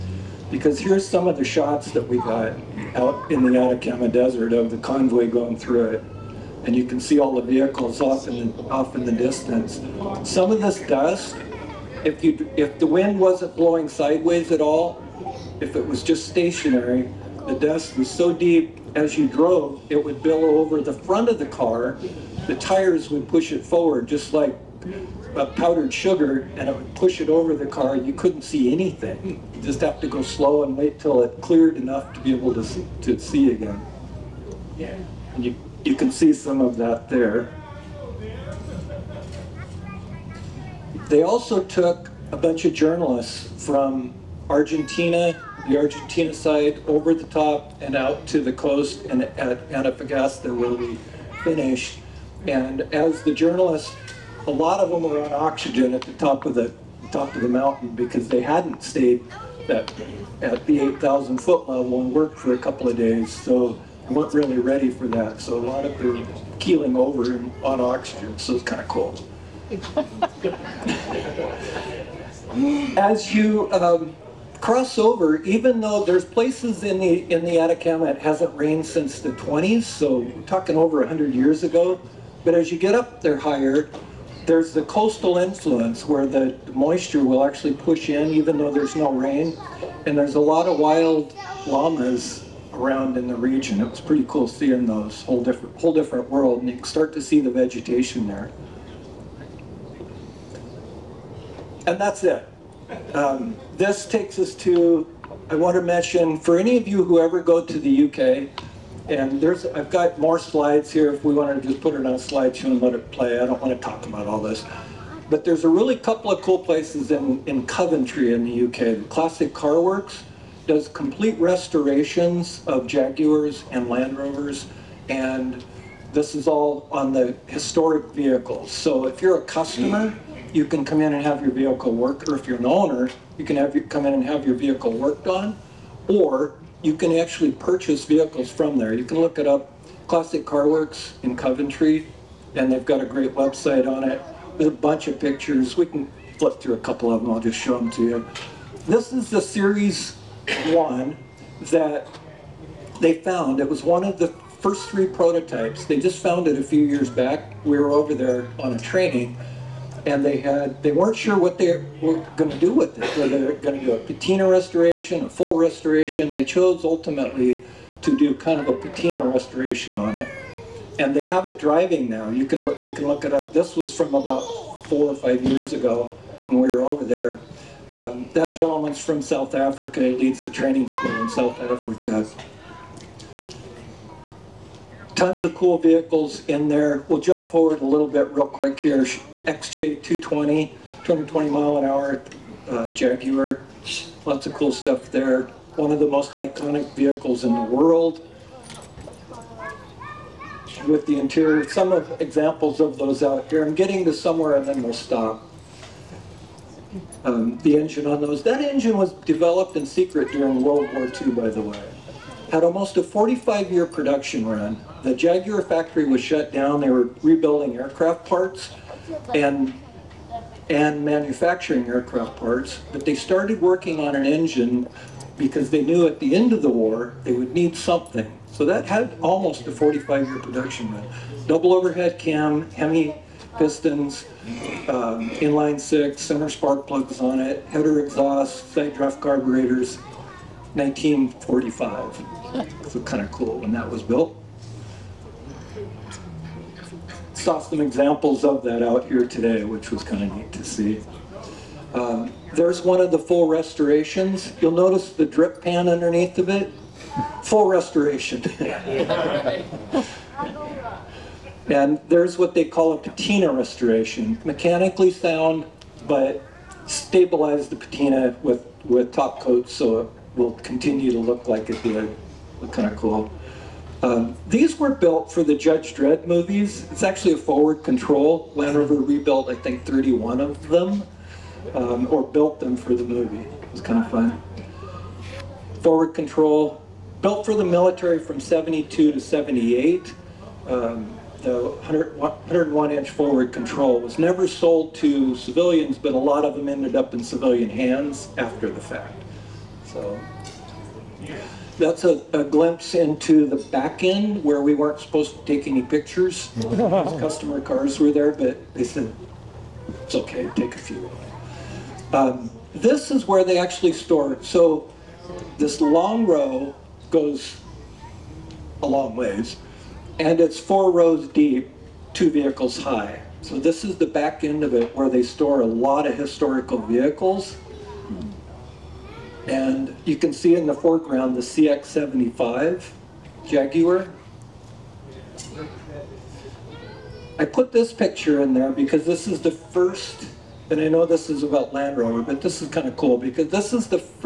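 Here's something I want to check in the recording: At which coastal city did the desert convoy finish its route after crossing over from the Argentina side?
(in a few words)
Antofagasta.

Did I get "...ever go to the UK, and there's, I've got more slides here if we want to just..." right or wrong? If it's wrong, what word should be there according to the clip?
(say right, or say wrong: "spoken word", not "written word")
right.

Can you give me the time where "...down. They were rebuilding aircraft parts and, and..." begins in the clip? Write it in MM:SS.
03:36.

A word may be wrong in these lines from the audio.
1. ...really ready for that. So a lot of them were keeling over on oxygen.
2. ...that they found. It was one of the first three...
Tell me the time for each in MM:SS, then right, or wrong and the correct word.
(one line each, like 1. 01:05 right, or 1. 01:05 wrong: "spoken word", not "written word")
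1. 01:04 right
2. 02:31 right.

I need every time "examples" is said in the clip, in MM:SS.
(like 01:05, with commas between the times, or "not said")
03:22, 04:07.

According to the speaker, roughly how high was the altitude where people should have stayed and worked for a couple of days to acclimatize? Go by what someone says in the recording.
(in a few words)
8,000 feet.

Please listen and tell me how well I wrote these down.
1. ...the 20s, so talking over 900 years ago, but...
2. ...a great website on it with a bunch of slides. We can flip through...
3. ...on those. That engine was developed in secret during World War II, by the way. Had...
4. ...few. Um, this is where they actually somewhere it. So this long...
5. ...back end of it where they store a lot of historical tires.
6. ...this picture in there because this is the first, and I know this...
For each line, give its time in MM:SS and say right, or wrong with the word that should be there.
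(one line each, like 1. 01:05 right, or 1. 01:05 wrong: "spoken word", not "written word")
1. 01:19 wrong: "100", not "900"
2. 02:22 wrong: "pictures", not "slides"
3. 03:28 right
4. 05:10 wrong: "store", not "somewhere"
5. 05:24 wrong: "vehicles", not "tires"
6. 05:37 right.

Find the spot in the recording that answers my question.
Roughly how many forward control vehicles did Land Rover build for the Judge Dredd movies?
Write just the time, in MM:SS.
04:39.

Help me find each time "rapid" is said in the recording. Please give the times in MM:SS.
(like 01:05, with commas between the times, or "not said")
not said.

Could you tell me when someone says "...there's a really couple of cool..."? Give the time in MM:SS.
01:55.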